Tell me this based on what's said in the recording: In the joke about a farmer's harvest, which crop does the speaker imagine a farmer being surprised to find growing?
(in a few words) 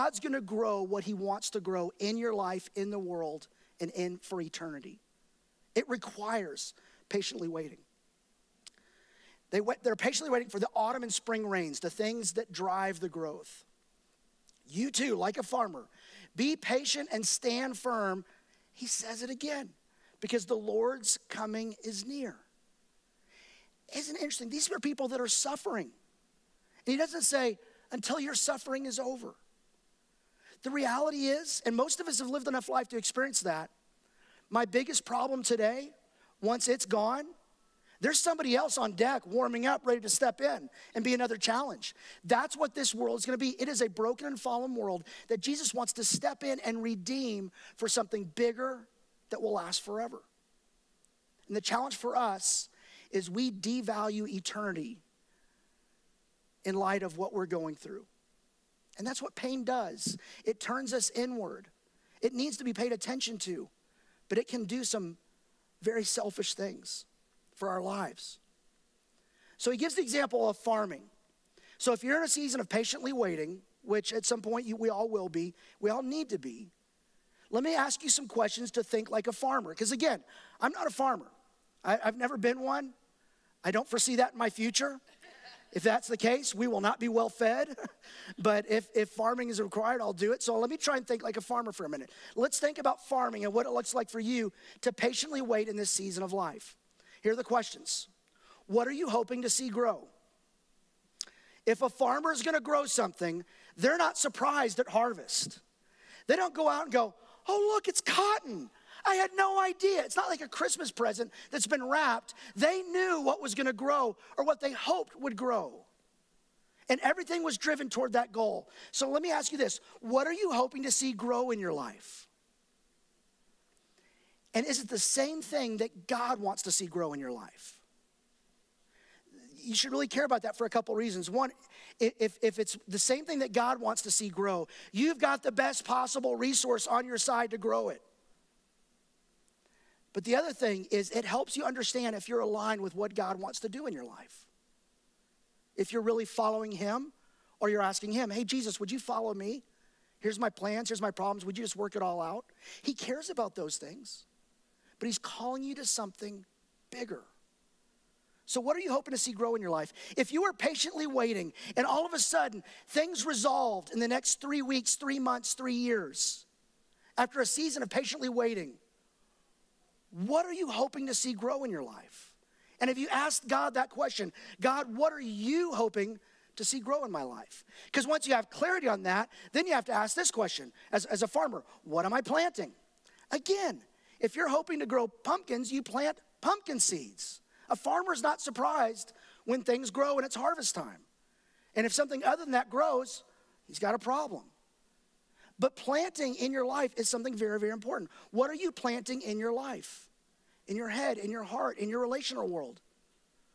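cotton.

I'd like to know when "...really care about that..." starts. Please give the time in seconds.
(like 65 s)
129 s.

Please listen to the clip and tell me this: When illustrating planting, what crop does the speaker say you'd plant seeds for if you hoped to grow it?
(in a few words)
pumpkins.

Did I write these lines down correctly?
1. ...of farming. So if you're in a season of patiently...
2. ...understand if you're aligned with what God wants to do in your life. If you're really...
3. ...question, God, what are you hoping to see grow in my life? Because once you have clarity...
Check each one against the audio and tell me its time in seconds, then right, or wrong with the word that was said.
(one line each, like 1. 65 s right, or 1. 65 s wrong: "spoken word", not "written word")
1. 70 s right
2. 141 s right
3. 173 s right.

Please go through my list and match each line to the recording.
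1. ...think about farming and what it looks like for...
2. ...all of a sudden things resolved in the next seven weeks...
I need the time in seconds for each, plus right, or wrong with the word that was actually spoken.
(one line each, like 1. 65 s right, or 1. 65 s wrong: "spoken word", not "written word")
1. 92 s right
2. 161 s wrong: "three", not "seven".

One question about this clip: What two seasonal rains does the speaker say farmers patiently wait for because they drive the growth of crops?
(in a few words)
autumn and spring rains.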